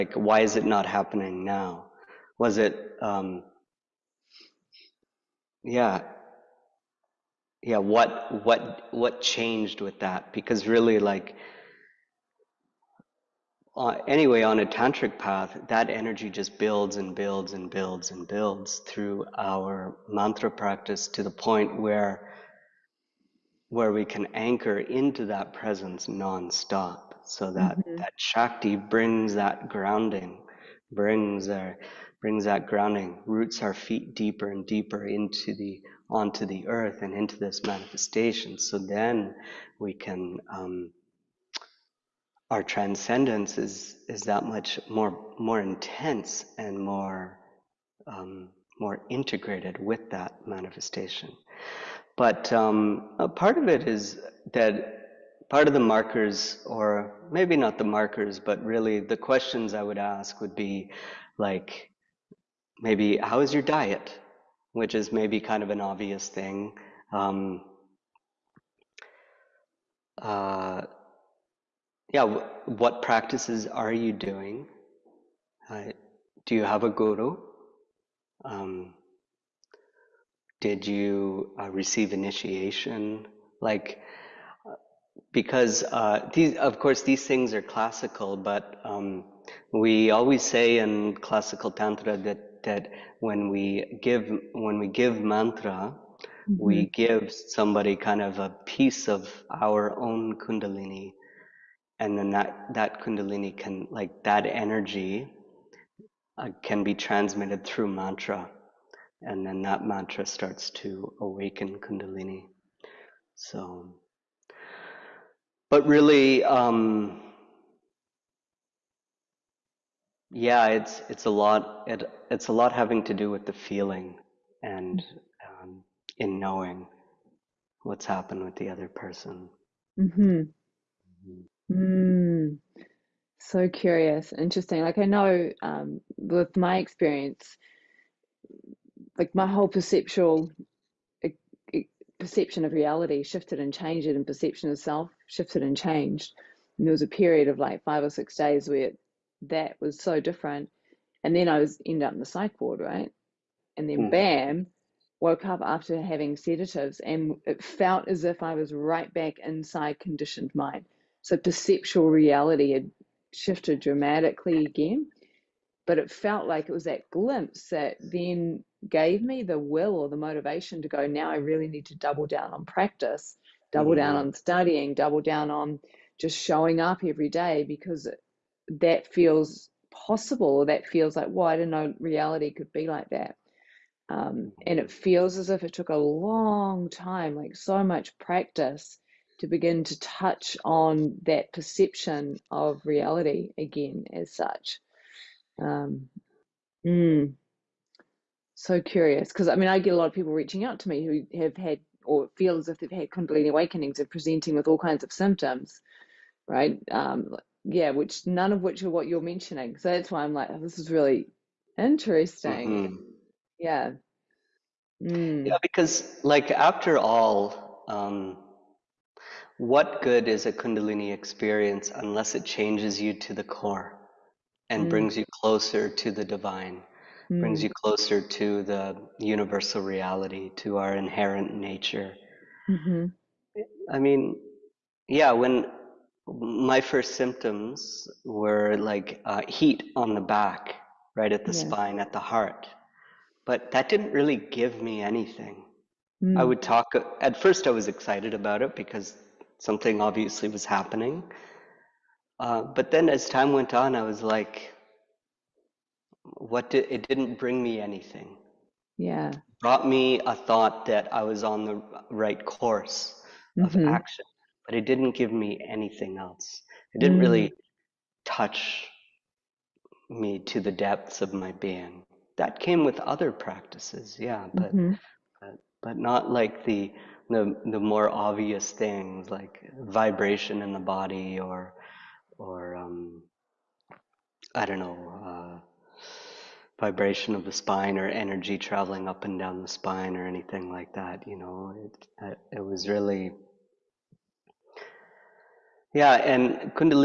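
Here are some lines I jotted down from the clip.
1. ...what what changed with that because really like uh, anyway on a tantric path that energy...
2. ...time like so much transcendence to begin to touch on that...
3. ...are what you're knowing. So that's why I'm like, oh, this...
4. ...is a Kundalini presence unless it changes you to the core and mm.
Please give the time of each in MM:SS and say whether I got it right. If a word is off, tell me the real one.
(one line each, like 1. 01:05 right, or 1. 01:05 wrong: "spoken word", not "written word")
1. 00:08 right
2. 03:06 wrong: "practice", not "transcendence"
3. 03:28 wrong: "mentioning", not "knowing"
4. 03:40 wrong: "experience", not "presence".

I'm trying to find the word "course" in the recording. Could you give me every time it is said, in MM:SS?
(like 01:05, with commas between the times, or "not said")
01:26, 04:22.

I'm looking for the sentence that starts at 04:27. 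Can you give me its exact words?
really touch me to the depths of my being.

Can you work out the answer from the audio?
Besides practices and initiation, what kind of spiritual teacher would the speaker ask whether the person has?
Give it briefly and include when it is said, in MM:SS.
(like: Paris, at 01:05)
a guru, at 01:16.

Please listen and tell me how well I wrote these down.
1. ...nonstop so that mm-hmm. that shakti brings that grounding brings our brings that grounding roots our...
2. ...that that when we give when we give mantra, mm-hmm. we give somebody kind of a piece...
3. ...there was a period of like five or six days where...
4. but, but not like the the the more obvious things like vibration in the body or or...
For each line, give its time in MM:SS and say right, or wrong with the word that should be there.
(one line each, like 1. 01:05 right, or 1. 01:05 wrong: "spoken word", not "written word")
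1. 00:26 right
2. 01:32 right
3. 02:26 right
4. 04:35 right.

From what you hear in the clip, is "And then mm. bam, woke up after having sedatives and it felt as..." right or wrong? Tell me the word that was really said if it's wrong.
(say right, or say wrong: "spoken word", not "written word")
right.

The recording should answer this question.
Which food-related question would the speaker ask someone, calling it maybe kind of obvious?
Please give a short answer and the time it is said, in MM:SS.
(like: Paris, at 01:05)
diet, at 01:03.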